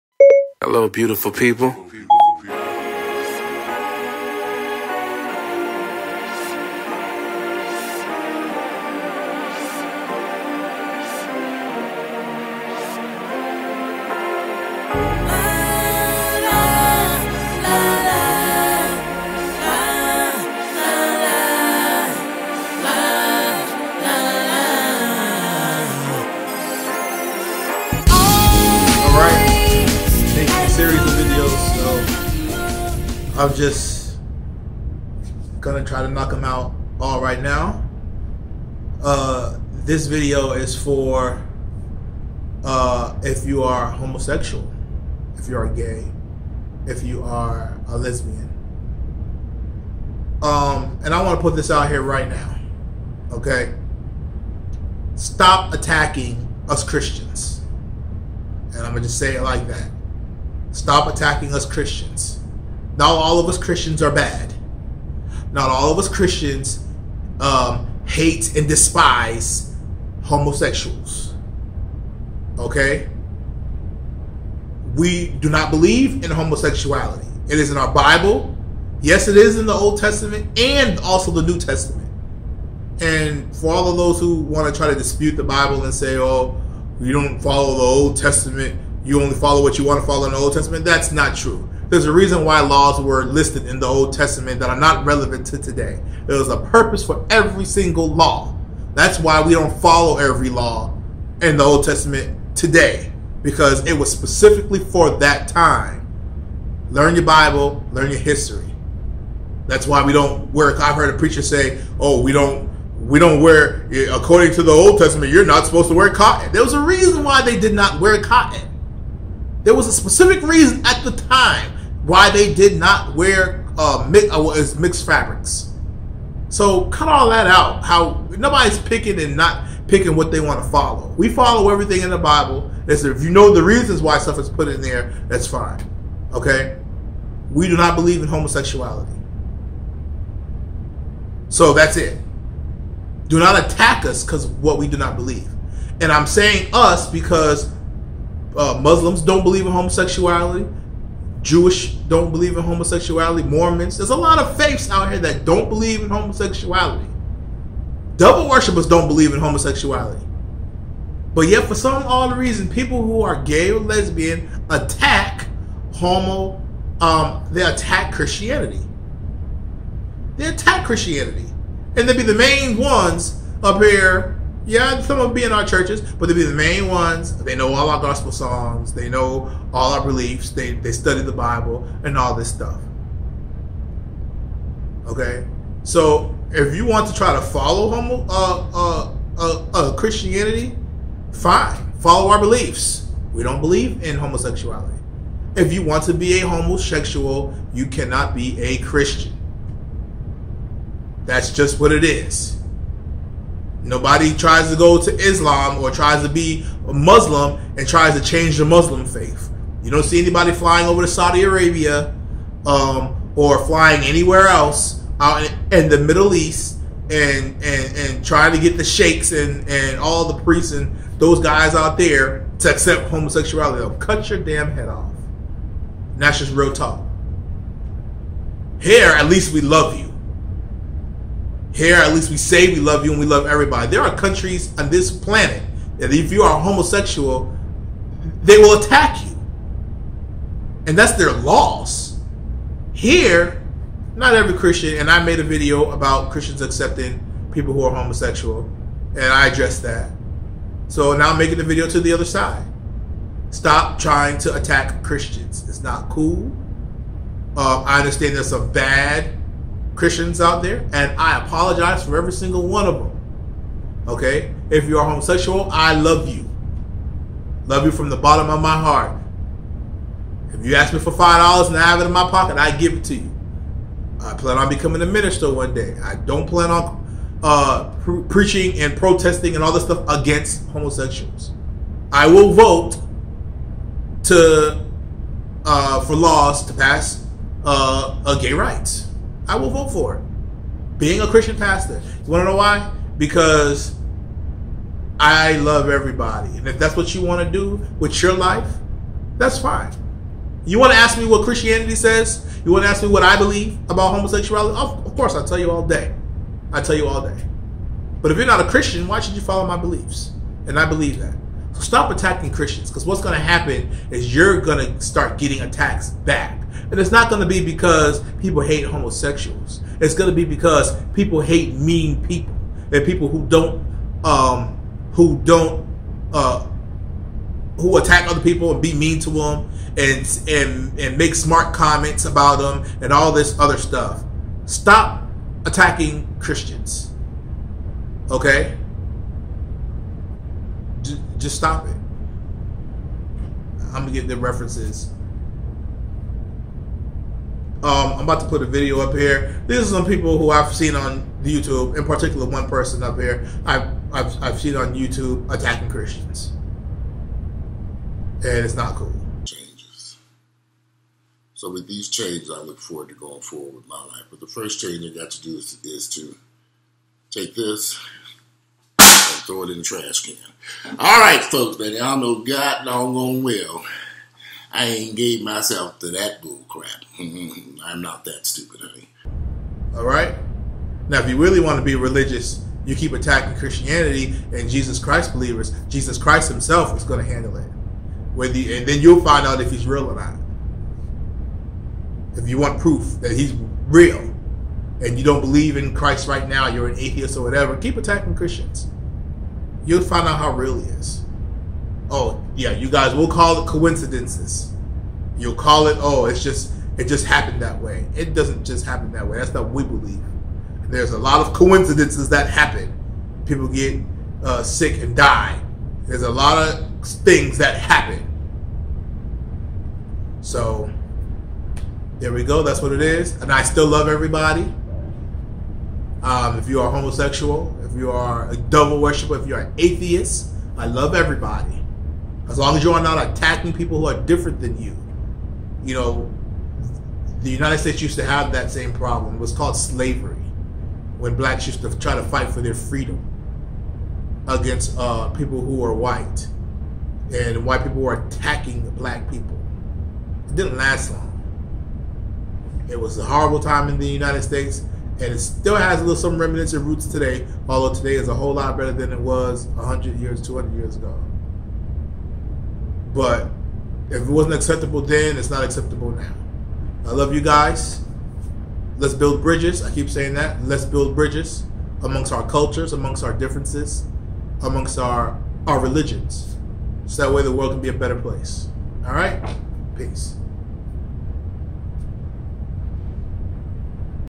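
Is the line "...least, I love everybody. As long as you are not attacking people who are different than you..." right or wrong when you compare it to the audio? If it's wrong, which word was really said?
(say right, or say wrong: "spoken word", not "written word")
wrong: "atheist", not "least".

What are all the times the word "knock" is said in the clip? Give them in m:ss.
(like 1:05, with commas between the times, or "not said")
0:36.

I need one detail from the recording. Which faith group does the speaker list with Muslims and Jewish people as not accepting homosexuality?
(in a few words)
Mormons.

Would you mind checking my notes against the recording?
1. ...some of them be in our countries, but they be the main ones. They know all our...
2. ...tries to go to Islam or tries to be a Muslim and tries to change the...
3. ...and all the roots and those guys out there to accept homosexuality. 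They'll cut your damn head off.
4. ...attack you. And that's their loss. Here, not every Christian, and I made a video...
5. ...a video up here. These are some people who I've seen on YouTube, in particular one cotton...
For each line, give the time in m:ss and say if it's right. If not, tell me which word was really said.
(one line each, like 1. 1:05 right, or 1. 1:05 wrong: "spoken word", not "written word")
1. 2:55 wrong: "churches", not "countries"
2. 3:24 right
3. 3:39 wrong: "priests", not "roots"
4. 3:58 right
5. 5:48 wrong: "person", not "cotton".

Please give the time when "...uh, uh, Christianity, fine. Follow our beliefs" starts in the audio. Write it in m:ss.
3:09.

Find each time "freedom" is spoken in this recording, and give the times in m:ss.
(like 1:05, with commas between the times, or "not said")
7:22.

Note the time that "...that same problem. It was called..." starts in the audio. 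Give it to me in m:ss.
7:18.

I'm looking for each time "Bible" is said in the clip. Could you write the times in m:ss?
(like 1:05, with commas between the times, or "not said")
1:17, 1:25, 1:47, 2:12, 3:01.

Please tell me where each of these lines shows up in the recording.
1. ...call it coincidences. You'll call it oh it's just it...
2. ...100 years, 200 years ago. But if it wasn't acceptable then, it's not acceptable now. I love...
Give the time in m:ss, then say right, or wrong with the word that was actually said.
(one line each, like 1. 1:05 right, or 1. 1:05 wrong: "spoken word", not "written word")
1. 6:43 right
2. 7:39 right.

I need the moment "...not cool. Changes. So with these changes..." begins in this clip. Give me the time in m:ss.
5:58.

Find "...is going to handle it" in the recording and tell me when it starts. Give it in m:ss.
6:26.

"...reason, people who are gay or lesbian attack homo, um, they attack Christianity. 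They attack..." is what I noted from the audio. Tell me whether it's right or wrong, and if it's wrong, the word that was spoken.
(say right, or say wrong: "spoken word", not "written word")
right.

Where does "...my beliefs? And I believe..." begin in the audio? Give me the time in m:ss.
5:09.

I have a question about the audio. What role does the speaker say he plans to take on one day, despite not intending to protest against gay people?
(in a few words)
minister.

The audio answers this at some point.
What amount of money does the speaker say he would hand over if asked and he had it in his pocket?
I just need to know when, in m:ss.
4:31.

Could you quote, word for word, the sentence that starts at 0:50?
Um, and I want to put this out here right now, okay?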